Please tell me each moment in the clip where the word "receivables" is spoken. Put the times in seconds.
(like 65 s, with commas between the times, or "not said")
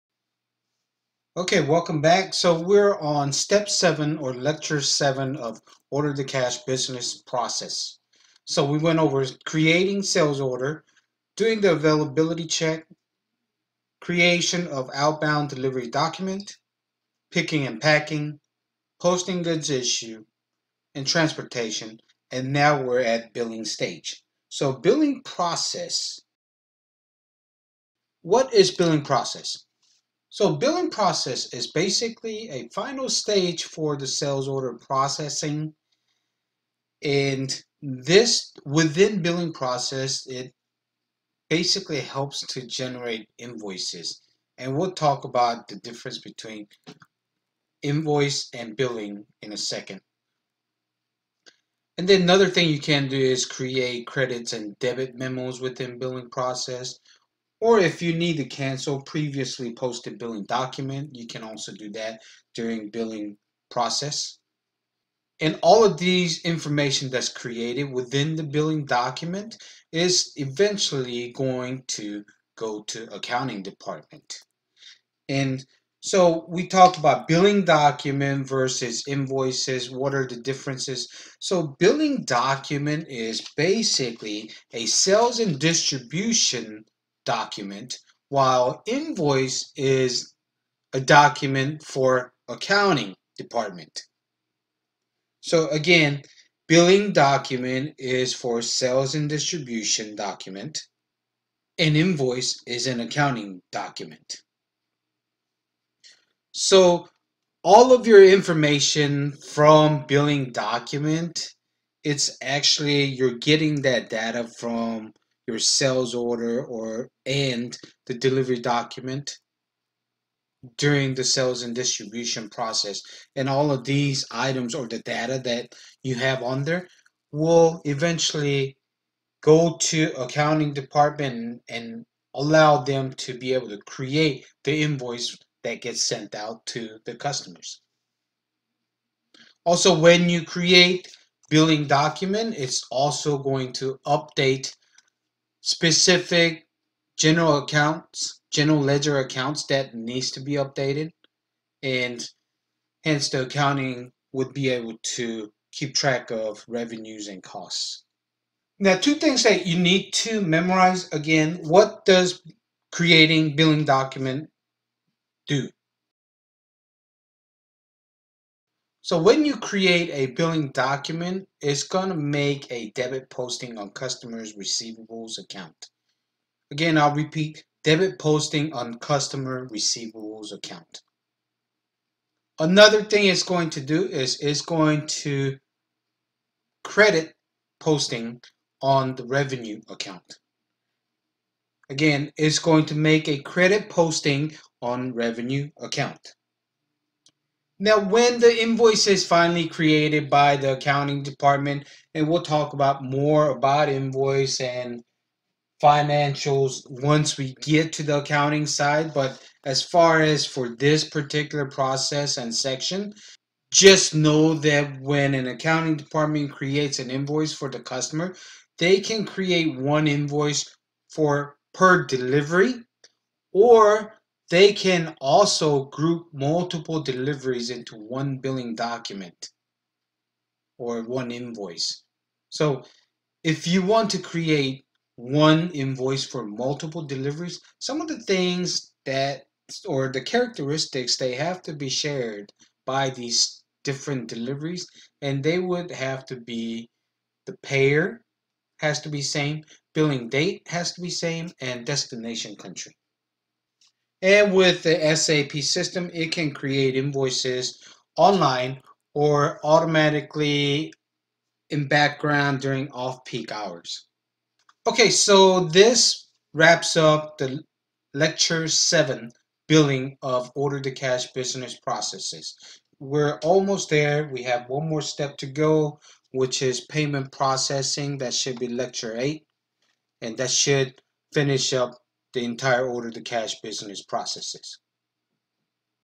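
174 s, 179 s.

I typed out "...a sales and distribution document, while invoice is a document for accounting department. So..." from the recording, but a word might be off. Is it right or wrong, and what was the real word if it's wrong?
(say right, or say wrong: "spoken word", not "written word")
right.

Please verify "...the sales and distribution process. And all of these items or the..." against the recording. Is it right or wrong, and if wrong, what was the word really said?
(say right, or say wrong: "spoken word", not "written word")
right.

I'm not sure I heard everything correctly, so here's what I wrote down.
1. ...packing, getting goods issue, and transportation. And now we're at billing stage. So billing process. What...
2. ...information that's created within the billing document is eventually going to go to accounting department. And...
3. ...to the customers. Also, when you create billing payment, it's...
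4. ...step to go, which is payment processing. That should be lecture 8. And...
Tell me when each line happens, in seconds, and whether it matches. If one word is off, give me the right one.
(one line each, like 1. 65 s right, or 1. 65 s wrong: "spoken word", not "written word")
1. 17 s wrong: "posting", not "getting"
2. 66 s right
3. 136 s wrong: "document", not "payment"
4. 275 s right.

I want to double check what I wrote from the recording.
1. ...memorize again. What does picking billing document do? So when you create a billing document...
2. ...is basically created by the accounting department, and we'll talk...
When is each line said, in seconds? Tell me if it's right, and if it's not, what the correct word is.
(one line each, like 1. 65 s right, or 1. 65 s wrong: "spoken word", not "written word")
1. 160 s wrong: "creating", not "picking"
2. 199 s wrong: "finally", not "basically".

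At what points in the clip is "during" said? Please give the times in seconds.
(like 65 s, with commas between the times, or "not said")
62 s, 120 s, 262 s.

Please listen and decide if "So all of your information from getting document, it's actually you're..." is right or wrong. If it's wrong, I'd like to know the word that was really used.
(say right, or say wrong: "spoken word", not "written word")
wrong: "billing", not "getting".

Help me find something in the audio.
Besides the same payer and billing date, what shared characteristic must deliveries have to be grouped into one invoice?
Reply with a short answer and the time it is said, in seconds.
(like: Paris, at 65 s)
destination country, at 251 s.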